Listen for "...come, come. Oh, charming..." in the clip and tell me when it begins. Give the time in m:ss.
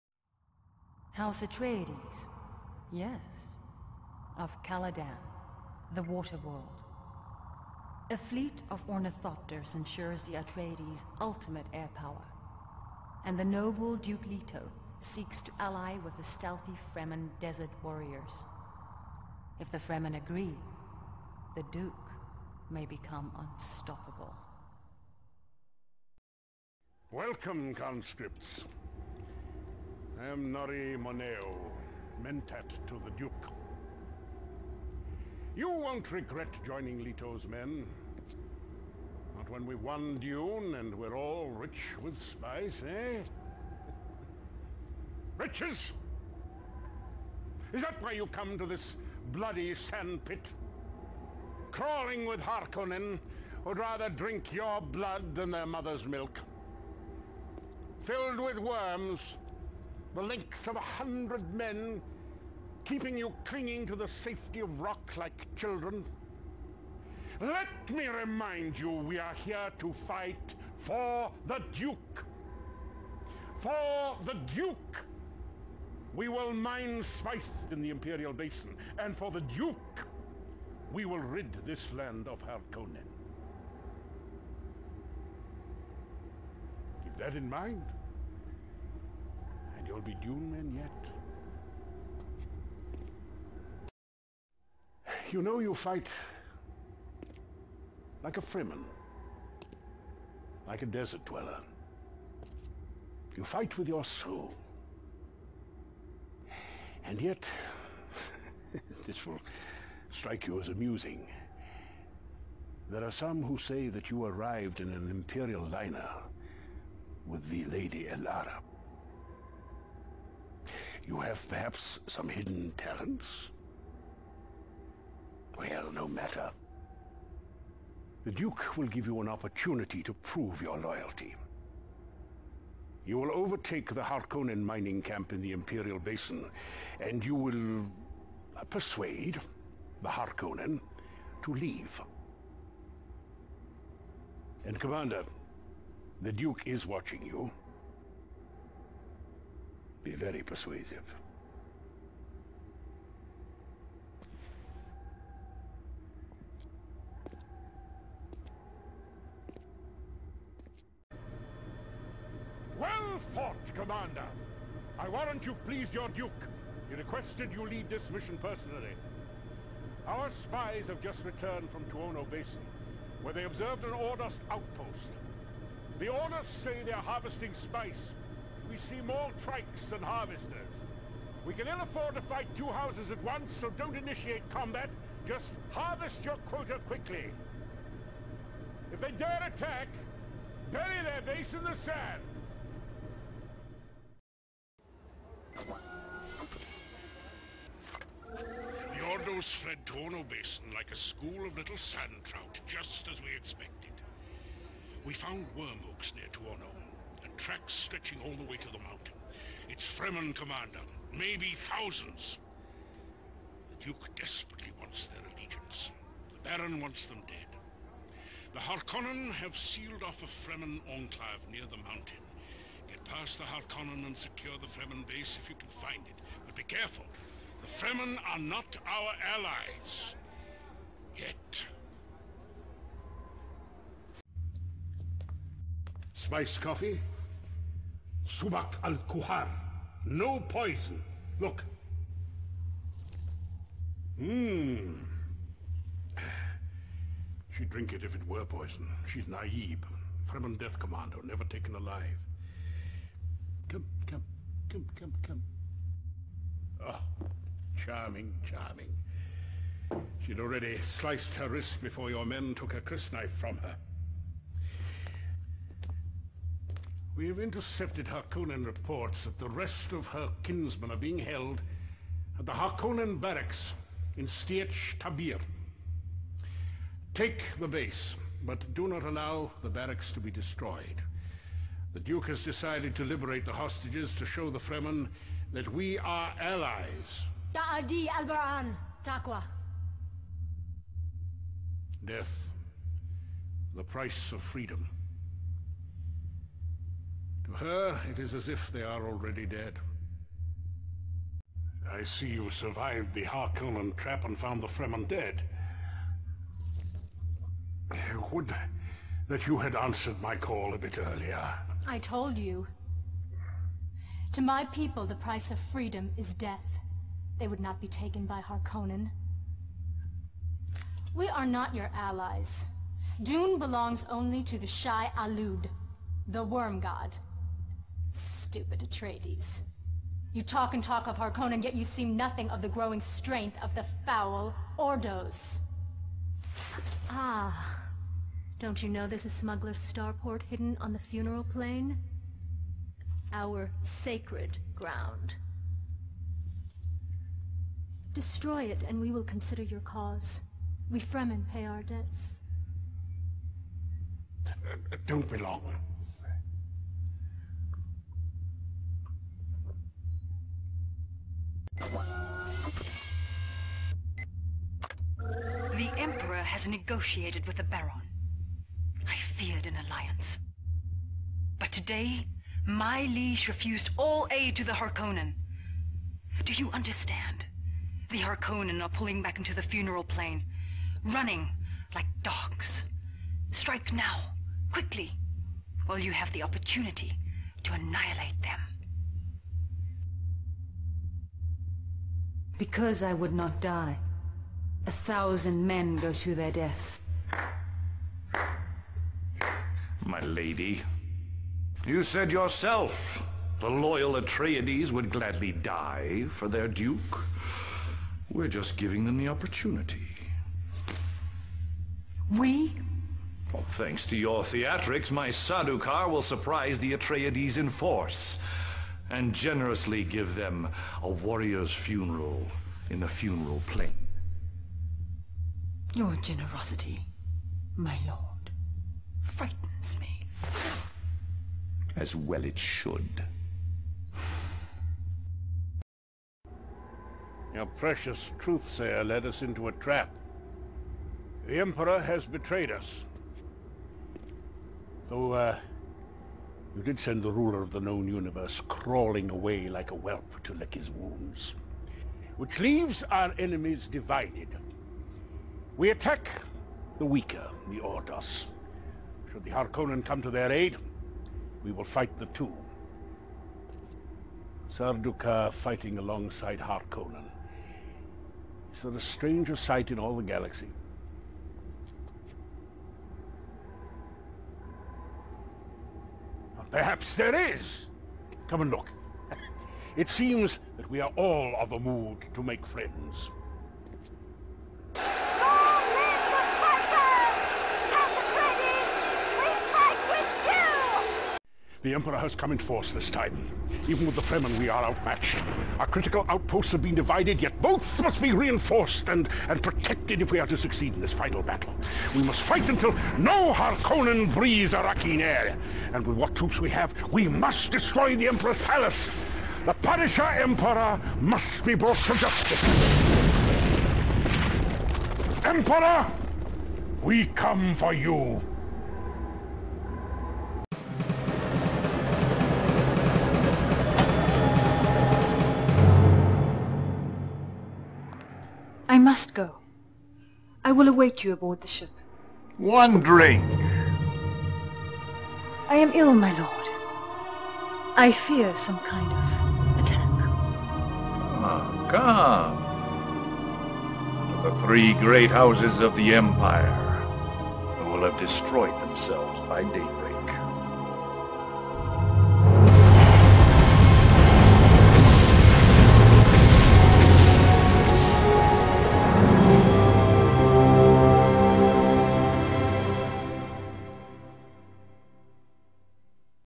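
4:14.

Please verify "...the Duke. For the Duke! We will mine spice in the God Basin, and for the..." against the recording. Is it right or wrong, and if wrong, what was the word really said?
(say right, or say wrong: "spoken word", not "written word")
wrong: "Imperial", not "God".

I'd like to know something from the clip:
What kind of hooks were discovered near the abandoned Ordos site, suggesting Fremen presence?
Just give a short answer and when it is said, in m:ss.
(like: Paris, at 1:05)
Worm hooks, at 3:25.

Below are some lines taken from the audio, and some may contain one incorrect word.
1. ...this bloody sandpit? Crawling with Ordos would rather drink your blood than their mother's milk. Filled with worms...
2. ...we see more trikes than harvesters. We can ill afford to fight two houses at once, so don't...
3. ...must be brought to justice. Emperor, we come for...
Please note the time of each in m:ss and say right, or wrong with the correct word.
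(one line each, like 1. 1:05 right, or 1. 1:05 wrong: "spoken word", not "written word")
1. 0:48 wrong: "Harkonnen", not "Ordos"
2. 2:58 right
3. 8:31 right.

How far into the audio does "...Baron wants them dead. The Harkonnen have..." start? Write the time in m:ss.
3:36.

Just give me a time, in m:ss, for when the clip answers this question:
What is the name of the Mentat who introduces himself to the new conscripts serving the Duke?
0:30.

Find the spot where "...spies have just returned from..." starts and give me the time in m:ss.
2:50.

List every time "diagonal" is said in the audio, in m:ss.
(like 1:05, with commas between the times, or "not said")
not said.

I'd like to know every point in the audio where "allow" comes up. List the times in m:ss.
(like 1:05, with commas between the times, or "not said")
4:39.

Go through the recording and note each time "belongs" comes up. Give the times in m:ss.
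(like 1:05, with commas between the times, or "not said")
5:23, 5:55.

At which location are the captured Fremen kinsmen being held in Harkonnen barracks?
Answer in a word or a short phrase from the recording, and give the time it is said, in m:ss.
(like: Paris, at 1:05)
Sietch Tabr, at 4:34.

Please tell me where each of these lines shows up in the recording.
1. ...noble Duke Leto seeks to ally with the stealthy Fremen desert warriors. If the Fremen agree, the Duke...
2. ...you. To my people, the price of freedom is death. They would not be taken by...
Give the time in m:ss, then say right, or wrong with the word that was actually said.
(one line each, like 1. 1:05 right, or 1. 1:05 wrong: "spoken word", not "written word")
1. 0:13 right
2. 5:12 right.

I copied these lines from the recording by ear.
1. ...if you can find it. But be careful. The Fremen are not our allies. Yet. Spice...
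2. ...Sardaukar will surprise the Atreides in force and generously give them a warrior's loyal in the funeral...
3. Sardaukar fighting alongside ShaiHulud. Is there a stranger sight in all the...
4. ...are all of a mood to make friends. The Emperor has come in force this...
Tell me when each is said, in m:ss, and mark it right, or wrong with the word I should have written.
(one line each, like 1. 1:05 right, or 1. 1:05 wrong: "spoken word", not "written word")
1. 3:45 right
2. 6:55 wrong: "funeral", not "loyal"
3. 7:44 wrong: "Harkonnen", not "ShaiHulud"
4. 8:01 right.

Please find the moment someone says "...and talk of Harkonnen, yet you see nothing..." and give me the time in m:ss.
5:30.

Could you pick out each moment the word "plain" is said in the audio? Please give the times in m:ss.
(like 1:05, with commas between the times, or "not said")
5:41, 6:20, 7:03.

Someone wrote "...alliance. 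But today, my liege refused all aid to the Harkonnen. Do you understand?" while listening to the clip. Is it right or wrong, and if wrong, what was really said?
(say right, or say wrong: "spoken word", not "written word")
right.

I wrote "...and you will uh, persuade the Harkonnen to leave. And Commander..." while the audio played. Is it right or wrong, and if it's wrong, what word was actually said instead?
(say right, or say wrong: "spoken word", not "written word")
right.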